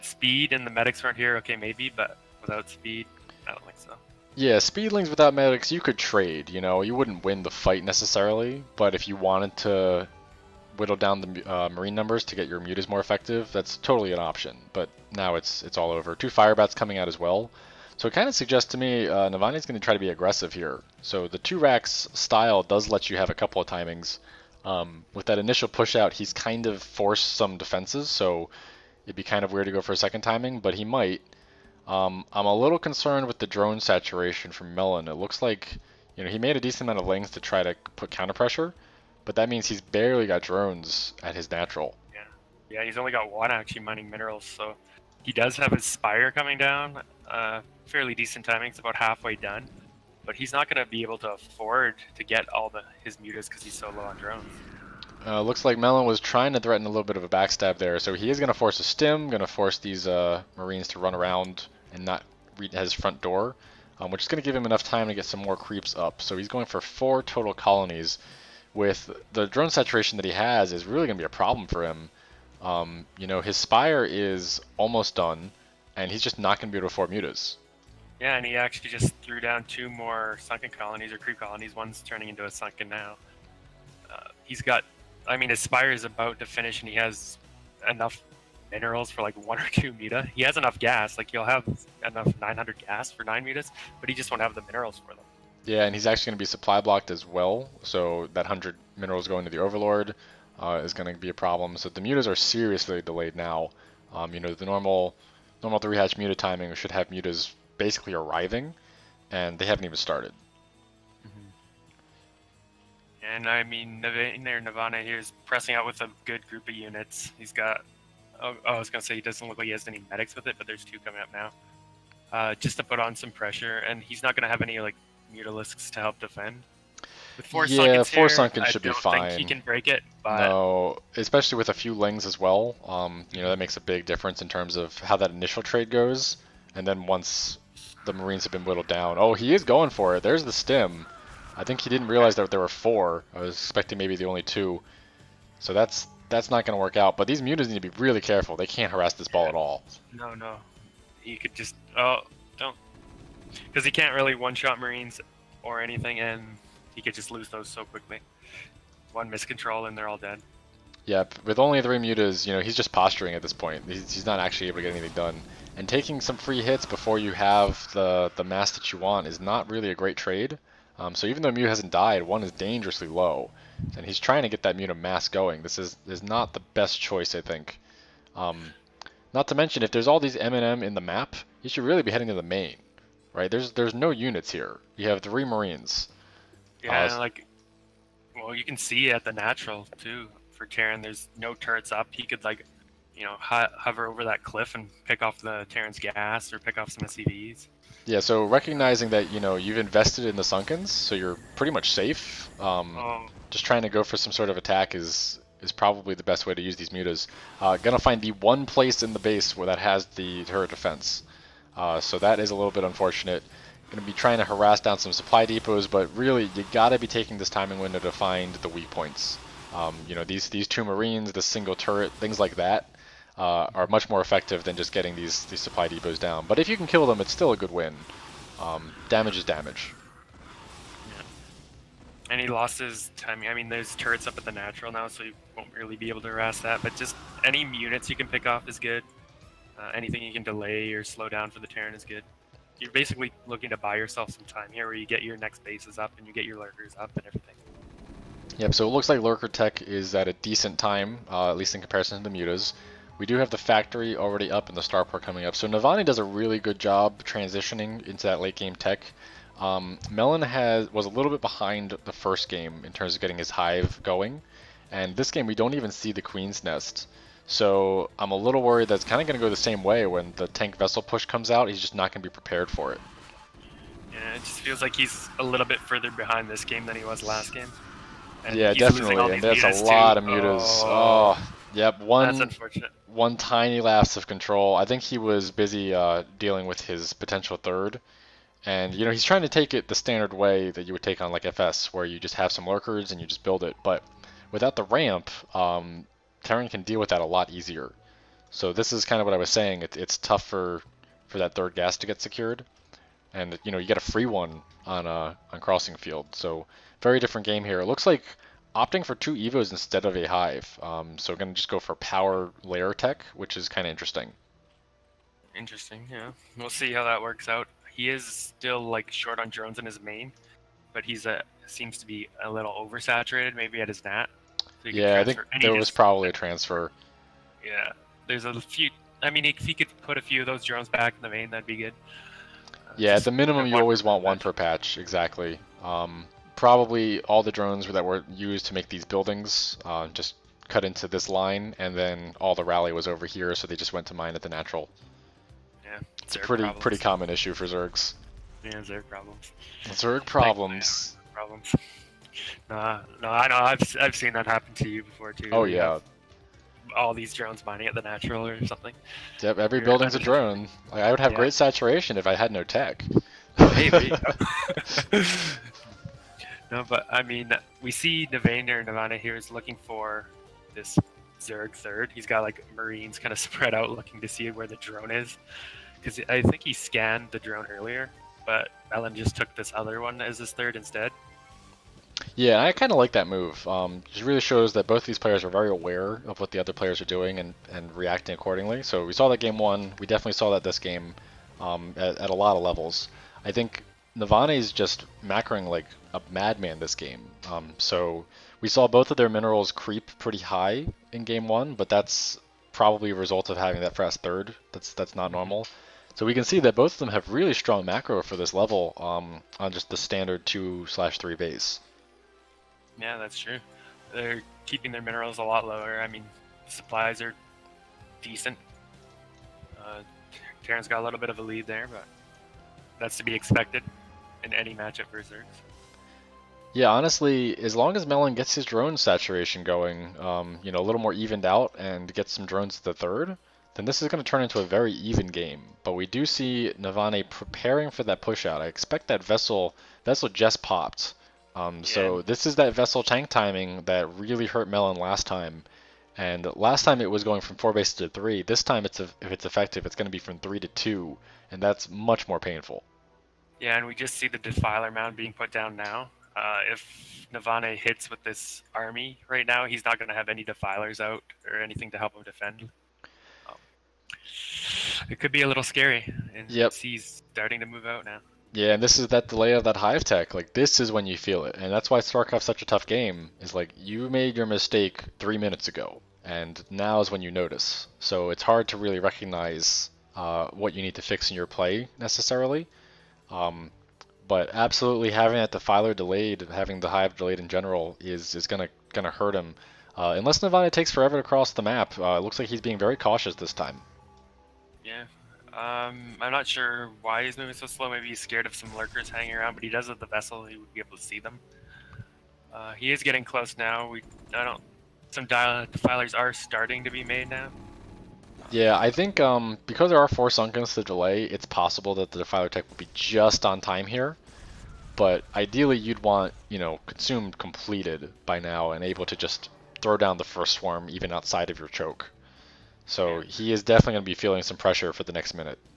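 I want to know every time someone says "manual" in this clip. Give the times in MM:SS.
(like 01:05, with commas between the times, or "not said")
not said.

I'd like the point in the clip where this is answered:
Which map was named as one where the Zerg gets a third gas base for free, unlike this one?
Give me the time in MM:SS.
05:05.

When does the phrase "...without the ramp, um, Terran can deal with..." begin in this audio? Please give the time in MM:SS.
04:54.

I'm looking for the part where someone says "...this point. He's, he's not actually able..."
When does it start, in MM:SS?
02:43.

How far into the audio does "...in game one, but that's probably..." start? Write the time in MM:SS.
06:41.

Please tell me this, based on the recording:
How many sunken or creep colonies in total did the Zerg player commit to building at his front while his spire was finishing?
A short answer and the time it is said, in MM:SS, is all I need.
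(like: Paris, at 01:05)
4, at 01:06.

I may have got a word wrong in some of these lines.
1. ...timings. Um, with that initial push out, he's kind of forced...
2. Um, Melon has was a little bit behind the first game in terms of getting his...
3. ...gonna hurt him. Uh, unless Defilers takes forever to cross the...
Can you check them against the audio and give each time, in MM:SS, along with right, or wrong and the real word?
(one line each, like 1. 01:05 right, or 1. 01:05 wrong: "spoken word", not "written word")
1. 00:23 right
2. 04:19 right
3. 08:08 wrong: "Navane", not "Defilers".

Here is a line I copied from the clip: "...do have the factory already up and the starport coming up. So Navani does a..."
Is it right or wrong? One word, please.
right.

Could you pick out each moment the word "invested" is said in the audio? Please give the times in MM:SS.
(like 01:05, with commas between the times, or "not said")
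03:19.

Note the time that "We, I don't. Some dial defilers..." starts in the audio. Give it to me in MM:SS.
08:23.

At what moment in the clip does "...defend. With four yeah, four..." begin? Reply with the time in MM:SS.
02:06.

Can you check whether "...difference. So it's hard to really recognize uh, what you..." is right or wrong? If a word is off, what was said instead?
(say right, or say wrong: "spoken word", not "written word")
wrong: "notice", not "difference".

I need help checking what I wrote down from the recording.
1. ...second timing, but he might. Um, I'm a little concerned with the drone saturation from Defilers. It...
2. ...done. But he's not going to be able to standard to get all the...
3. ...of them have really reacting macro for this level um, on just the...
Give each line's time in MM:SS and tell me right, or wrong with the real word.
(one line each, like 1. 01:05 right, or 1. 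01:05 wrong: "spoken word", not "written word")
1. 00:29 wrong: "Melon", not "Defilers"
2. 00:49 wrong: "afford", not "standard"
3. 06:46 wrong: "strong", not "reacting".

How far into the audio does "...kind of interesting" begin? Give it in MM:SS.
05:13.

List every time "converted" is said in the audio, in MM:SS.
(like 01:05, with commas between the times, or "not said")
not said.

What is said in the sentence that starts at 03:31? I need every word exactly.
Uh, so that is a little bit unfortunate.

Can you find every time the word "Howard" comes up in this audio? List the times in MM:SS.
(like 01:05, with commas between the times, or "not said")
not said.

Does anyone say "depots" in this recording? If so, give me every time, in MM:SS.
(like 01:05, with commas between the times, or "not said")
03:35, 03:45.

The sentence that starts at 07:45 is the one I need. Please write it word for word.
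It could be a little scary.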